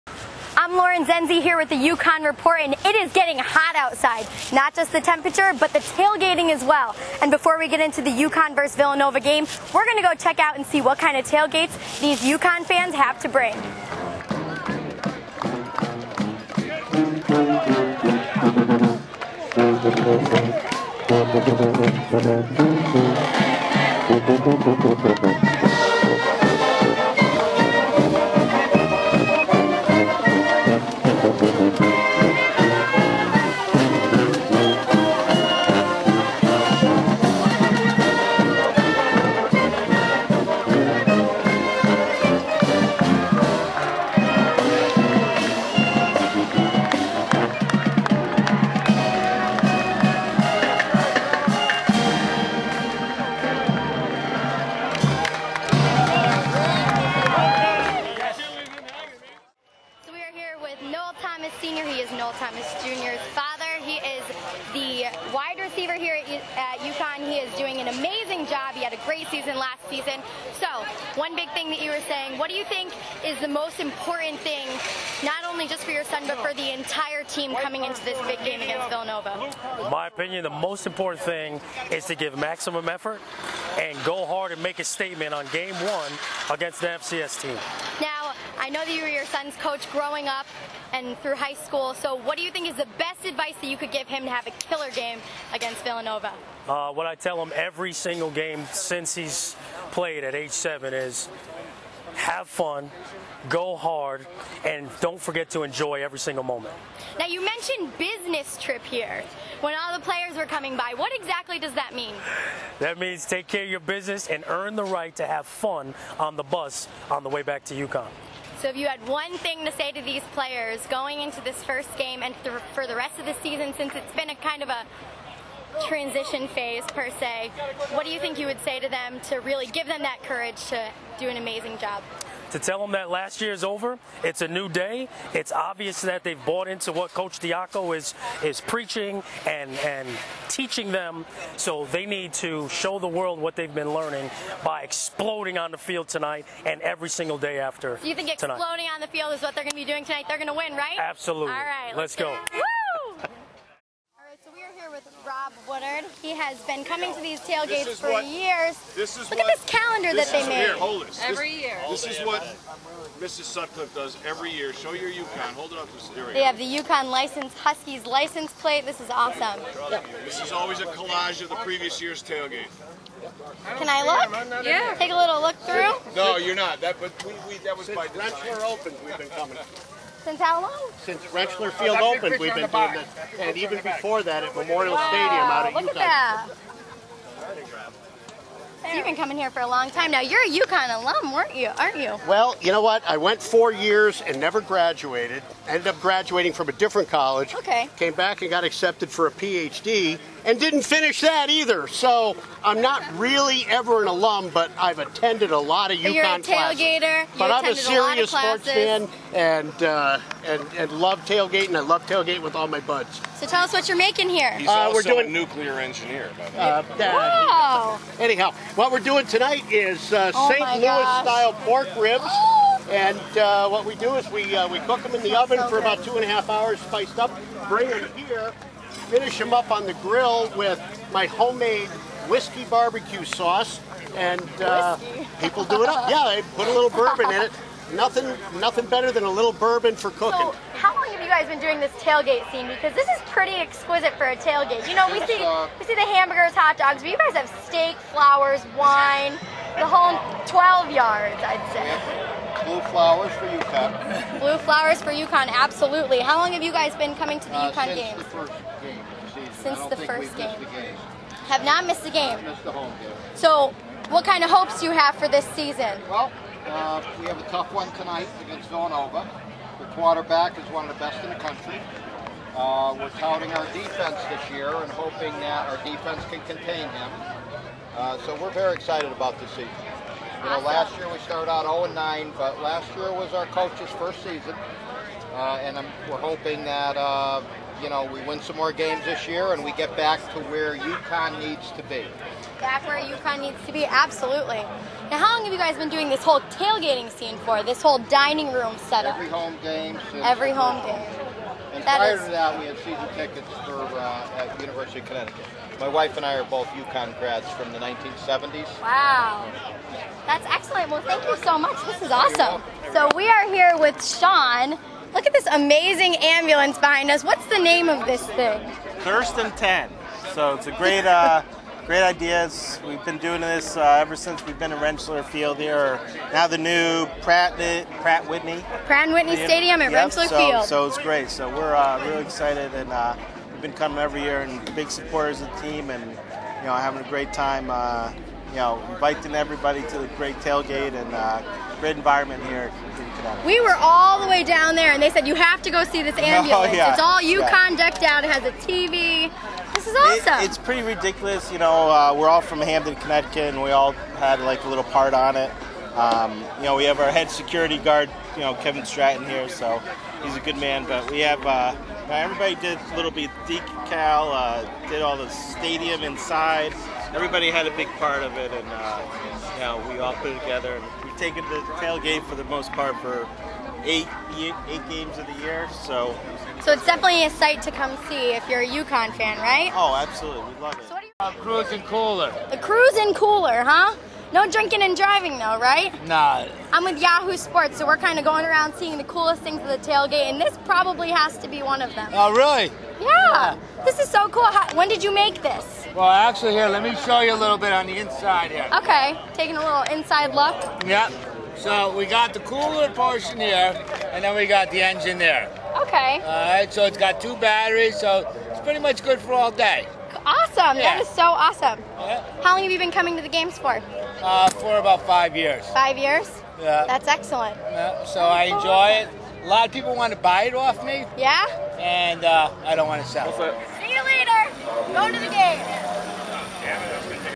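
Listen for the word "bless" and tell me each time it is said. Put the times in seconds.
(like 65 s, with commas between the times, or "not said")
not said.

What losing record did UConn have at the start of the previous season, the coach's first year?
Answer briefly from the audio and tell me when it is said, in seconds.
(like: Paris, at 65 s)
0-9, at 281 s.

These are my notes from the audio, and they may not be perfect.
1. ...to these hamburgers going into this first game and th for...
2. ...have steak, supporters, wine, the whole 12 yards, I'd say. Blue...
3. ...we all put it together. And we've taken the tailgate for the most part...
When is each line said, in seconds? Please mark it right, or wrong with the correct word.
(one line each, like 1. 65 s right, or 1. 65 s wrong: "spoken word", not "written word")
1. 119 s wrong: "players", not "hamburgers"
2. 247 s wrong: "flowers", not "supporters"
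3. 369 s right.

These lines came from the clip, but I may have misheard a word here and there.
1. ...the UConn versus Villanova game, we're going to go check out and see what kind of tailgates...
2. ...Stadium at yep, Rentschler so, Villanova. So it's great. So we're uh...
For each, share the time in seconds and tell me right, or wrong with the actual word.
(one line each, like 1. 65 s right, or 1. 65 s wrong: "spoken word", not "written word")
1. 8 s right
2. 329 s wrong: "Field", not "Villanova".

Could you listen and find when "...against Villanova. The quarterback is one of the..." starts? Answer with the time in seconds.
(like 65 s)
268 s.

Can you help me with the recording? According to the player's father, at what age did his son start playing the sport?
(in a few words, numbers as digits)
7.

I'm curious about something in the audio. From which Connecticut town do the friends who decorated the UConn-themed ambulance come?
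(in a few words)
Hamden.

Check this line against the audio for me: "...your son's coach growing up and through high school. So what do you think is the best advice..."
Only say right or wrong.
right.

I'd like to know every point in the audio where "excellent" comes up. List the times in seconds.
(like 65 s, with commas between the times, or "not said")
310 s, 417 s.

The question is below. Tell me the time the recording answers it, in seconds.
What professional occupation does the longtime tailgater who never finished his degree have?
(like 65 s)
215 s.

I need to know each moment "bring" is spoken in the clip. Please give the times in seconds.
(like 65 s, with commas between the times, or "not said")
13 s, 227 s.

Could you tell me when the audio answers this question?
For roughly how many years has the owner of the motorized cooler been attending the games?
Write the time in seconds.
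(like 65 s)
414 s.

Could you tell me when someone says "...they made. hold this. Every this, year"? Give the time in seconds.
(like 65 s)
160 s.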